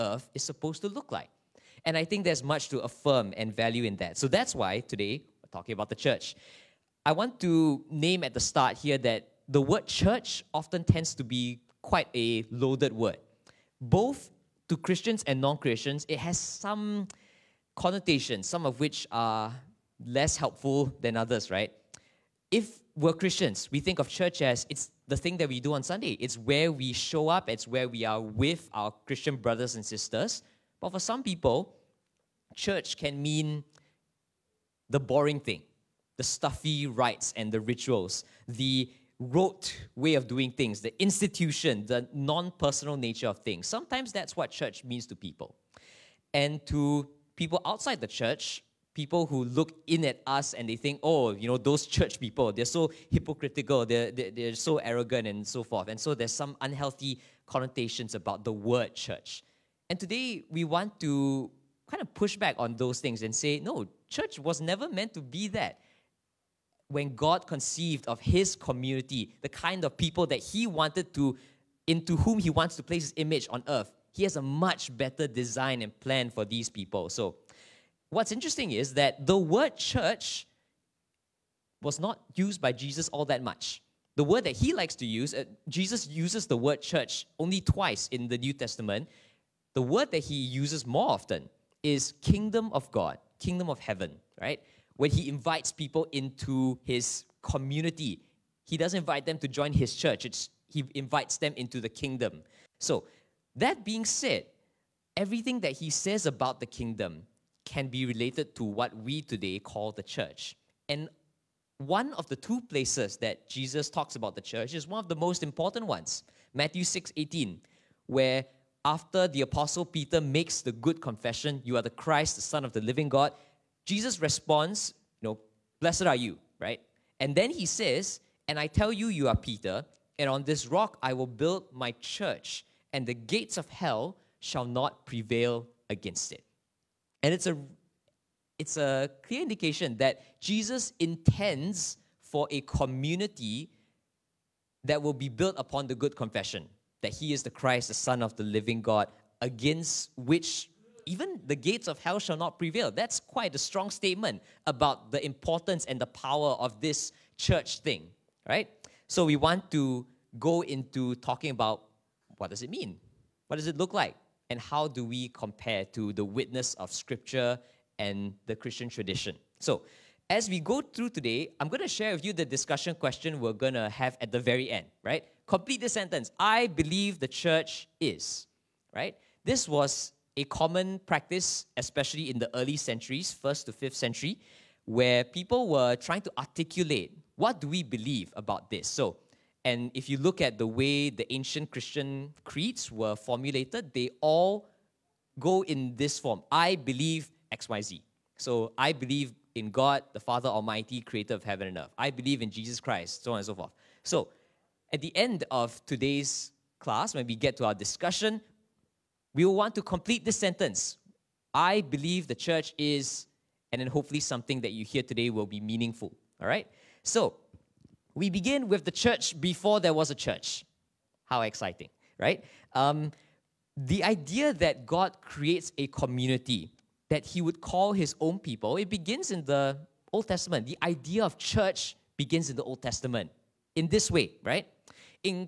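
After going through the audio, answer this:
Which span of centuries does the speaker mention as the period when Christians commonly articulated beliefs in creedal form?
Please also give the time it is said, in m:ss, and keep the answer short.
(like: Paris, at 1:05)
first to fifth century, at 3:03.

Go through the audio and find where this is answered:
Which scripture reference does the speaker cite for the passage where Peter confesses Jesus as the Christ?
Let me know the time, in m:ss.
1:56.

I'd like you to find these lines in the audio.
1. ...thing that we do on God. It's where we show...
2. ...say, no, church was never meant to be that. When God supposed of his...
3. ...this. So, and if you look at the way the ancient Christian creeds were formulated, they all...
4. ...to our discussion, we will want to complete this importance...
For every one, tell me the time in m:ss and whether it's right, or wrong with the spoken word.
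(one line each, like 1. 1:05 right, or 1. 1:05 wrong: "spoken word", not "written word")
1. 0:25 wrong: "Sunday", not "God"
2. 1:03 wrong: "conceived", not "supposed"
3. 3:08 right
4. 3:27 wrong: "sentence", not "importance".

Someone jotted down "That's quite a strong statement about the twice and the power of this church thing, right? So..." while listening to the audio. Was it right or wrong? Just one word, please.
wrong.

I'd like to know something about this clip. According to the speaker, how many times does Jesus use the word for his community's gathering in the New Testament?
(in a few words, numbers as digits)
2.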